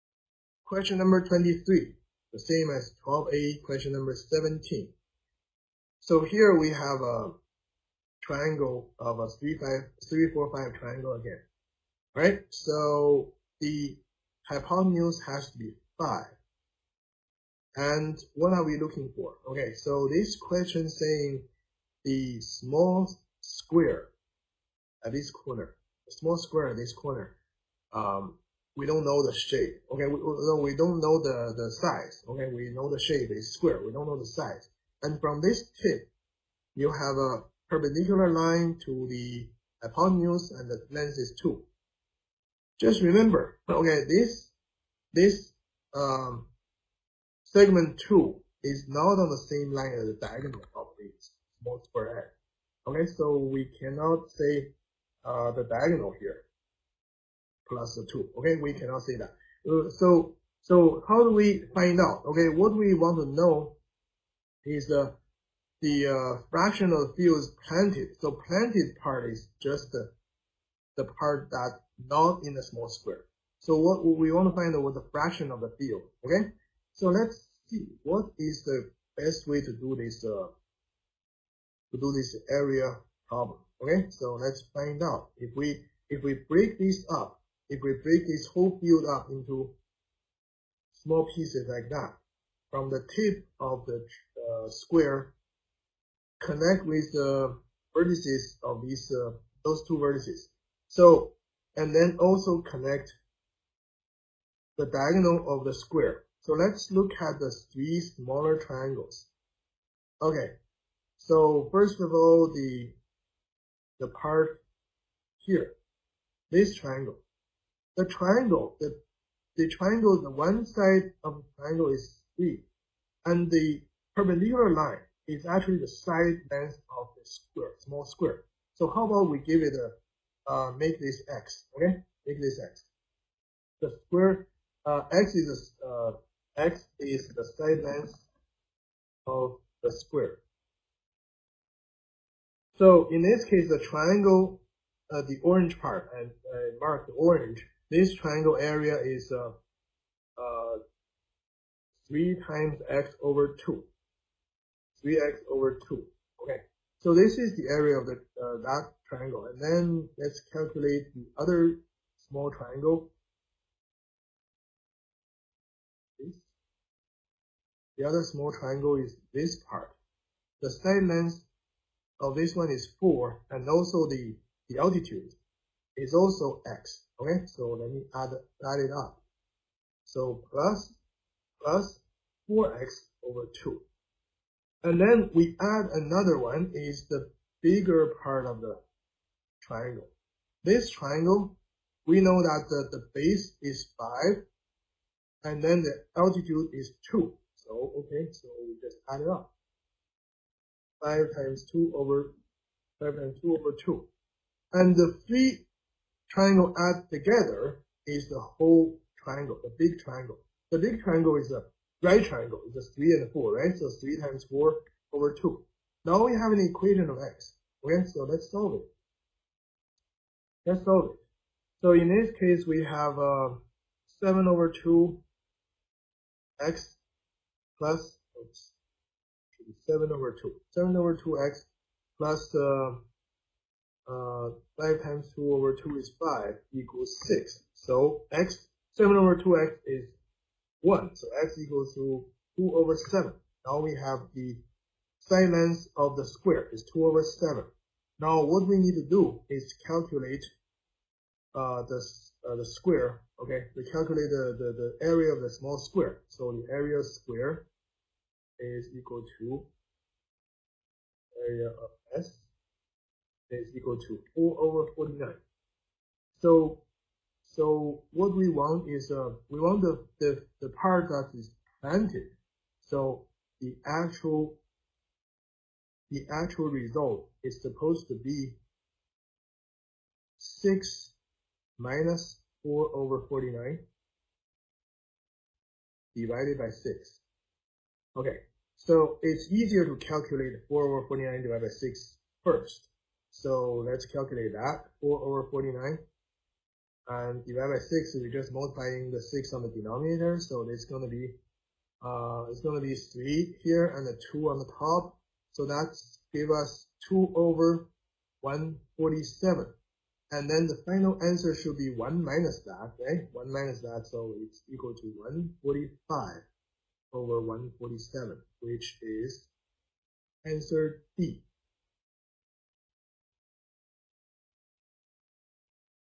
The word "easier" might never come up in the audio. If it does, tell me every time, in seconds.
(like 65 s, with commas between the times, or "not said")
289 s.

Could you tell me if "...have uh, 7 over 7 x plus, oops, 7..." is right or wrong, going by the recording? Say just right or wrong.
wrong.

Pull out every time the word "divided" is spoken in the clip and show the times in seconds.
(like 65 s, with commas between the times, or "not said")
286 s, 291 s, 297 s.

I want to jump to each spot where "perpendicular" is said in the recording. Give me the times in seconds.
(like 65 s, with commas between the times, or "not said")
37 s, 124 s.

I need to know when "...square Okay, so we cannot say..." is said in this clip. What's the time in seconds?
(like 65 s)
51 s.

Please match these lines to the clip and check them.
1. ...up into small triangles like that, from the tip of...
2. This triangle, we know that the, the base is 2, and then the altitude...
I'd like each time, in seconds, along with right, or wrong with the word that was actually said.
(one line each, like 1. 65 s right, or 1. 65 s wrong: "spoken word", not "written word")
1. 89 s wrong: "pieces", not "triangles"
2. 190 s wrong: "5", not "2".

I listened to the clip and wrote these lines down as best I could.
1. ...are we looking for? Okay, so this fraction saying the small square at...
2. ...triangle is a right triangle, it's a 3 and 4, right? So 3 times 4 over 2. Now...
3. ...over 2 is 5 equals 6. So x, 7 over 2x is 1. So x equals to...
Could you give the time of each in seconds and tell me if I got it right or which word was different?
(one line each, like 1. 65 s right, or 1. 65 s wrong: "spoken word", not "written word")
1. 18 s wrong: "question", not "fraction"
2. 211 s right
3. 235 s right.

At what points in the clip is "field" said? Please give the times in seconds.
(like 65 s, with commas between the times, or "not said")
67 s, 75 s, 88 s.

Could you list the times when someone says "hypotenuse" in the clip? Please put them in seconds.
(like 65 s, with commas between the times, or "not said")
14 s, 39 s.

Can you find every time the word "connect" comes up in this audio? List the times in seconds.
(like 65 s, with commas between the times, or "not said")
96 s, 102 s.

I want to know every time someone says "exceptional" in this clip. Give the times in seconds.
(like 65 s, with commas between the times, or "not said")
not said.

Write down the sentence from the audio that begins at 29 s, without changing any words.
Okay, we, we don't know the, the size.